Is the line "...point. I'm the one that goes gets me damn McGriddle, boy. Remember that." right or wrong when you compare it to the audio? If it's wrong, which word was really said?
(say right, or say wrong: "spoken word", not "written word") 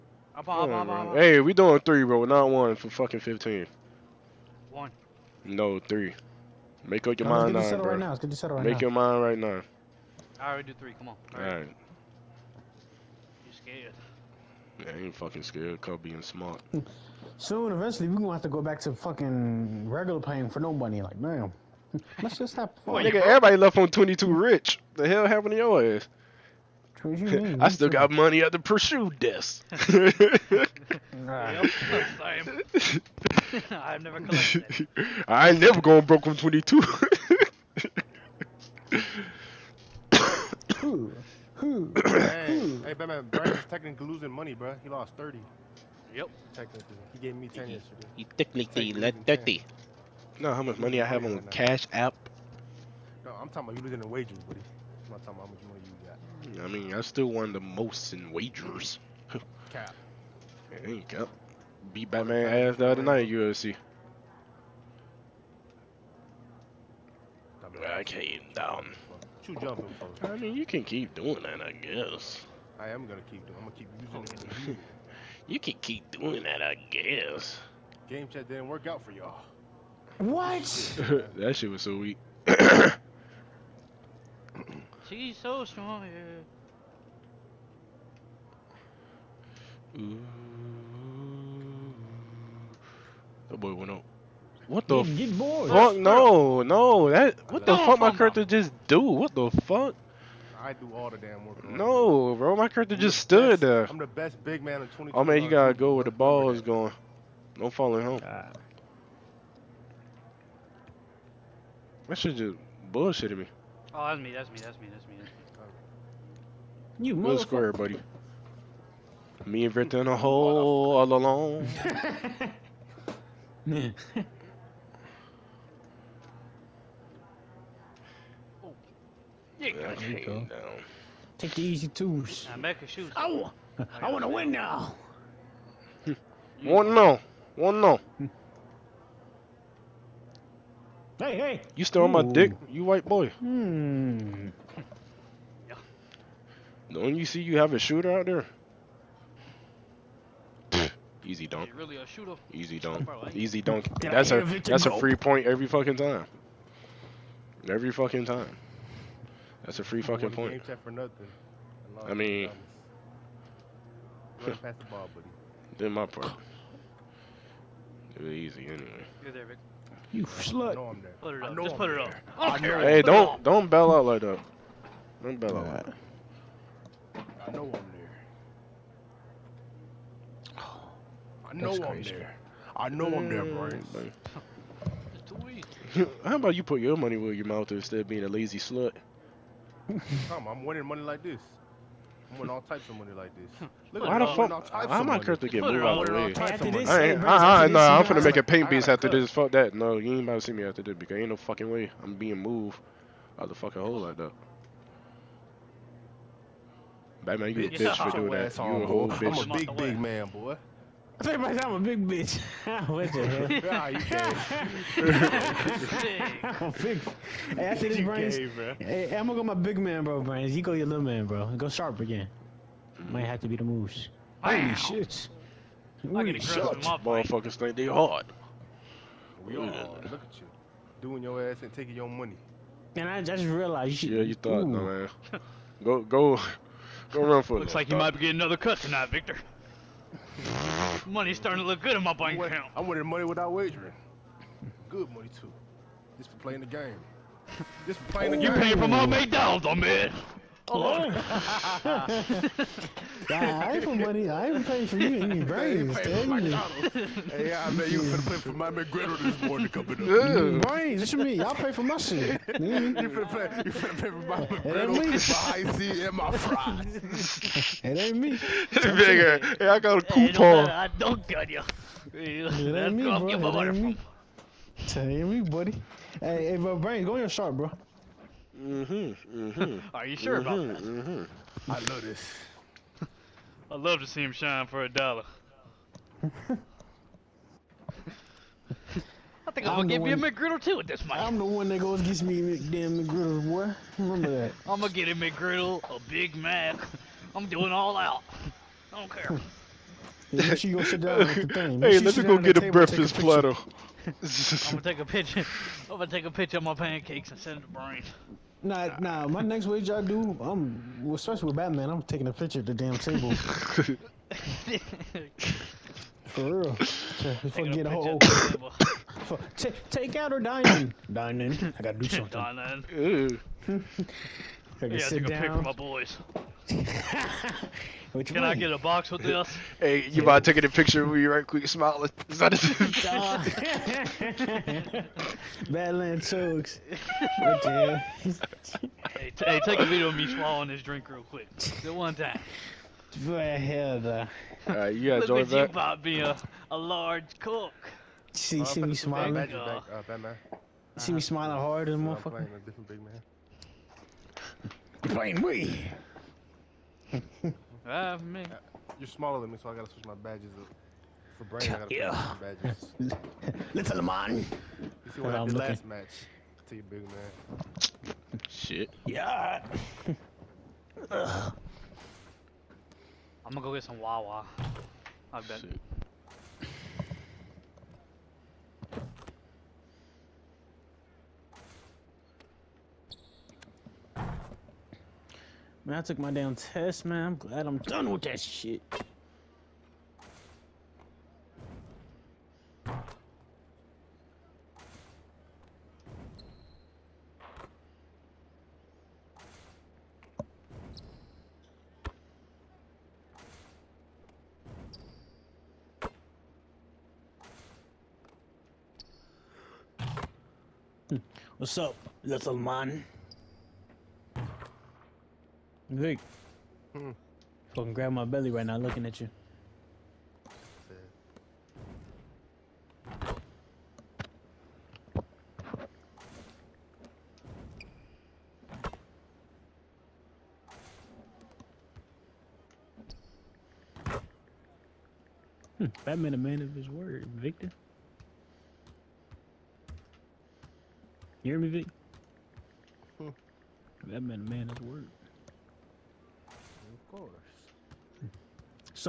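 right.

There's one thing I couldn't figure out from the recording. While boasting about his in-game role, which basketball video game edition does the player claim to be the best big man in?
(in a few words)
20.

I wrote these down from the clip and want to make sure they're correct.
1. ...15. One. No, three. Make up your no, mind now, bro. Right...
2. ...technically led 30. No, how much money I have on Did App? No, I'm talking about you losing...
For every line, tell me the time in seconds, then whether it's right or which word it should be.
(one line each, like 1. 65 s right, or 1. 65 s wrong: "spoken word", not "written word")
1. 3 s right
2. 48 s wrong: "Cash", not "Did".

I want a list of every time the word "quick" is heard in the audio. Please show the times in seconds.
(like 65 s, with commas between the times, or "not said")
331 s, 341 s.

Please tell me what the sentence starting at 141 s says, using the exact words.
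You still on my dick, you white boy.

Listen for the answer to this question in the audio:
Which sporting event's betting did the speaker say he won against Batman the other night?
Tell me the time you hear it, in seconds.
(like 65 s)
63 s.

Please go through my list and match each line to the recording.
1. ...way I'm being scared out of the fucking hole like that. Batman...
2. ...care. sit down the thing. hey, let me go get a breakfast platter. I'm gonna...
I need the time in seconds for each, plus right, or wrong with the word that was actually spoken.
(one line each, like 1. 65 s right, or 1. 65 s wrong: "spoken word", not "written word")
1. 201 s wrong: "moved", not "scared"
2. 299 s right.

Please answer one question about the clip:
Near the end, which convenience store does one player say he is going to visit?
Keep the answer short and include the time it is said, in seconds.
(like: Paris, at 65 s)
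Wawa, at 374 s.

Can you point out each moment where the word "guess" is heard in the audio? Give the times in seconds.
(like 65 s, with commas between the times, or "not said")
71 s, 76 s.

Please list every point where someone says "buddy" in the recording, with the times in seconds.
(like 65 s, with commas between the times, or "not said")
54 s, 117 s, 275 s.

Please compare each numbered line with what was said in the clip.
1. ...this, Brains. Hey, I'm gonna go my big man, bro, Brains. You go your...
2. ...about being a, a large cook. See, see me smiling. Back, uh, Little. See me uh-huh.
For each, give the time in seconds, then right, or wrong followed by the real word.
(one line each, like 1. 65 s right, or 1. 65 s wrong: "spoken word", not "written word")
1. 217 s right
2. 345 s wrong: "Batman", not "Little".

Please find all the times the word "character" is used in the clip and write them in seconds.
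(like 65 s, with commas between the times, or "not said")
98 s, 102 s.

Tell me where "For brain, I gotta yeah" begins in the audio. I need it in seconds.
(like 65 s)
361 s.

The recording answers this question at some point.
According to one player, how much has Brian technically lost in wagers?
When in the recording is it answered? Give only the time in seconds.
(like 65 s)
44 s.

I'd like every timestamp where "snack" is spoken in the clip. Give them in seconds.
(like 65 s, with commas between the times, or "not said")
not said.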